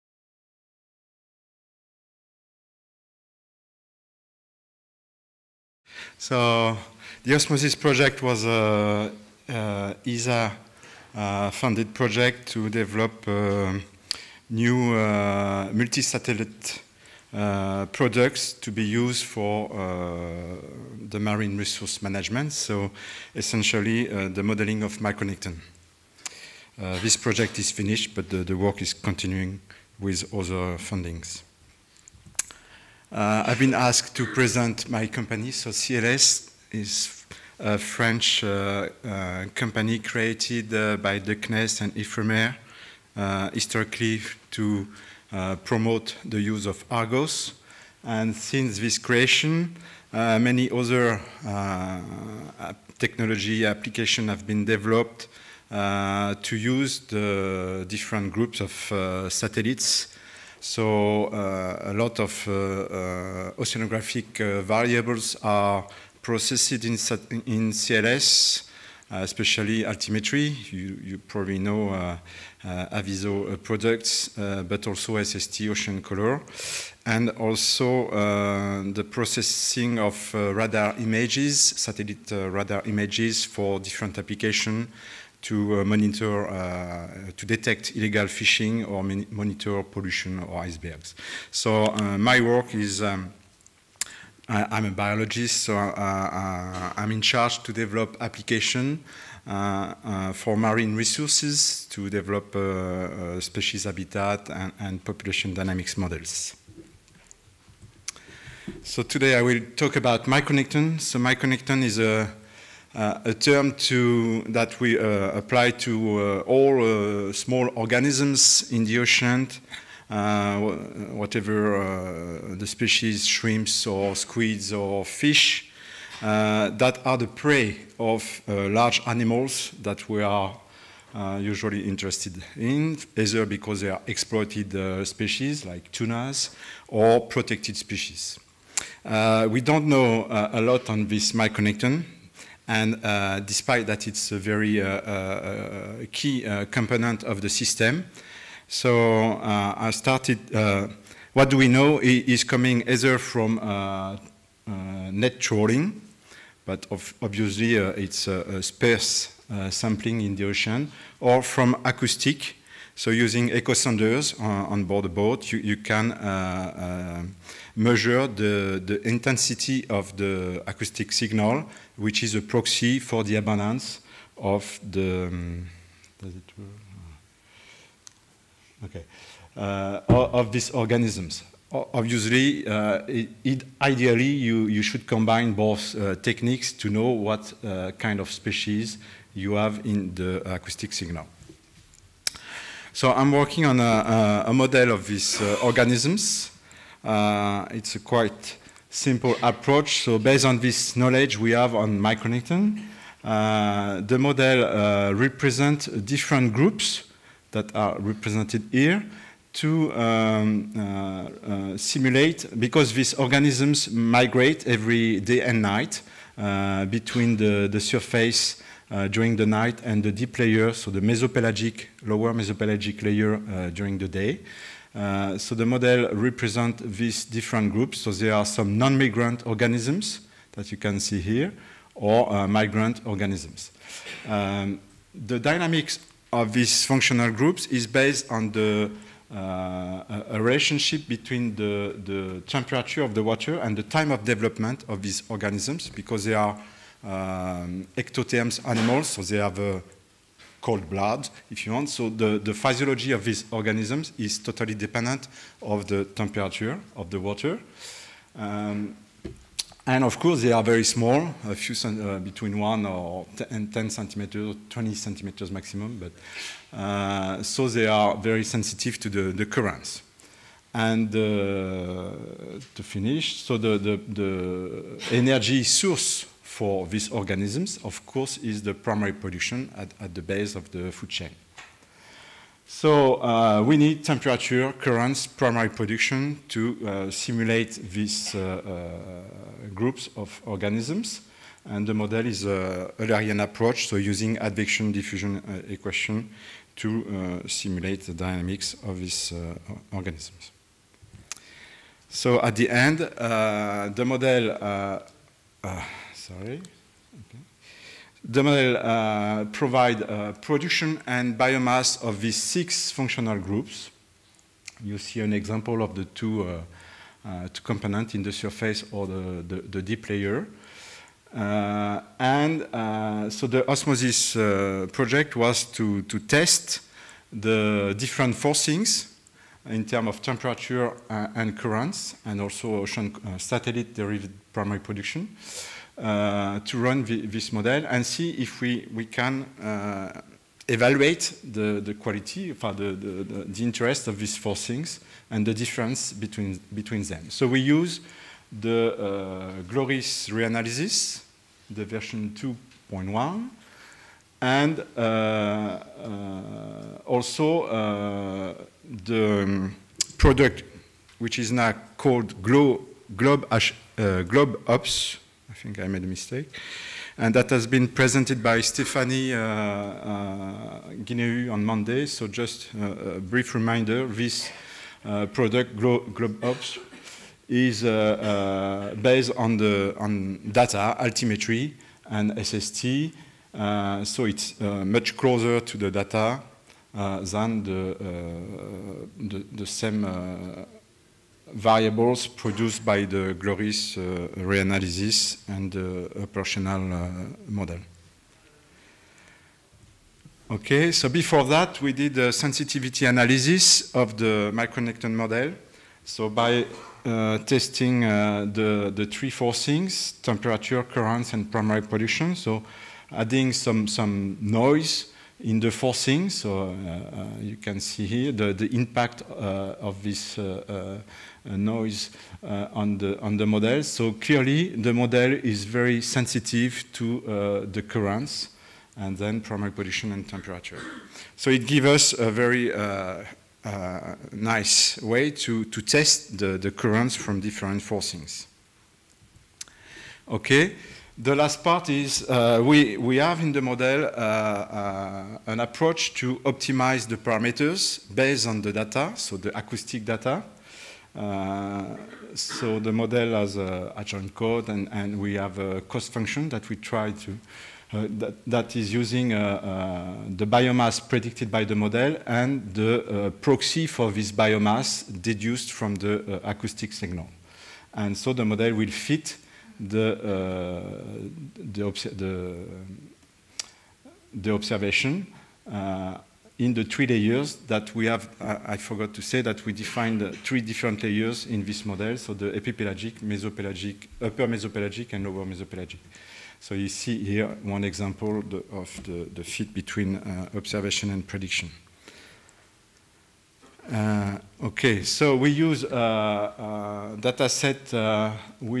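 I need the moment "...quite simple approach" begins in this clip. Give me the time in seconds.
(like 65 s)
197 s.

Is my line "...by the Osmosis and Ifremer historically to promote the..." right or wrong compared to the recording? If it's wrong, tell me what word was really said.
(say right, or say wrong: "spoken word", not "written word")
wrong: "CNES", not "Osmosis".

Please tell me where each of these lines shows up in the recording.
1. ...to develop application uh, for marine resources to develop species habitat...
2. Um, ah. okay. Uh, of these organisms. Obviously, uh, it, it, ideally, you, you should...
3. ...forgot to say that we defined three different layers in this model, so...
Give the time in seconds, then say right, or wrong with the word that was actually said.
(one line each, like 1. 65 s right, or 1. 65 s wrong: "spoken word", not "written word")
1. 97 s right
2. 175 s right
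3. 478 s right.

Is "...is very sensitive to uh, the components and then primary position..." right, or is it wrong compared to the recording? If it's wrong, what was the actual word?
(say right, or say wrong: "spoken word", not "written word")
wrong: "currents", not "components".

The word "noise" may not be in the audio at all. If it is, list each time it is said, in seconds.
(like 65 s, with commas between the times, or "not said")
414 s, 421 s.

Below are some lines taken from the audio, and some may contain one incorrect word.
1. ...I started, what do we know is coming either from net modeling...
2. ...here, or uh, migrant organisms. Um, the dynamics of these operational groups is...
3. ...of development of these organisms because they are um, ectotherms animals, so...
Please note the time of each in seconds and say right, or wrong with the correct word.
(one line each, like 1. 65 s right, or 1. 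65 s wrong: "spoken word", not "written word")
1. 149 s wrong: "trawling", not "modeling"
2. 231 s wrong: "functional", not "operational"
3. 244 s right.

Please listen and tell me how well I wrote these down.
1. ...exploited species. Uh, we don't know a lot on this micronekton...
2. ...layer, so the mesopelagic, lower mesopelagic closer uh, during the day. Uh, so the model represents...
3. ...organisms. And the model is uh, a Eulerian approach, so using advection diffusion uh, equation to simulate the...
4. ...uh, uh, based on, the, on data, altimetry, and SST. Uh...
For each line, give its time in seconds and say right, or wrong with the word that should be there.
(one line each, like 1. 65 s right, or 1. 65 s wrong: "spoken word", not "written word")
1. 137 s wrong: "protected", not "exploited"
2. 220 s wrong: "layer", not "closer"
3. 290 s right
4. 377 s right.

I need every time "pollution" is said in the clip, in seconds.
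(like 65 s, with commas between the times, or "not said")
89 s, 411 s.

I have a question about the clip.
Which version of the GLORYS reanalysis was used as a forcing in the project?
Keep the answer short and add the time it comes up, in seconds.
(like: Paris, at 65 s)
2.1, at 352 s.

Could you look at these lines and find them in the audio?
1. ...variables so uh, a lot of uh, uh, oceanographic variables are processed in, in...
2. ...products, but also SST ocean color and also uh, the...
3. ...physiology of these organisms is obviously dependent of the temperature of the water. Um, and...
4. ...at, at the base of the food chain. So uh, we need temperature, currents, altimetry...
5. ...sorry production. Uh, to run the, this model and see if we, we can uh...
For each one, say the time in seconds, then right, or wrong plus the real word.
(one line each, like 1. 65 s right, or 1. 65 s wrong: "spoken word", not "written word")
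1. 59 s wrong: "satellites", not "variables"
2. 73 s right
3. 252 s wrong: "totally", not "obviously"
4. 279 s wrong: "primary", not "altimetry"
5. 334 s wrong: "primary", not "sorry".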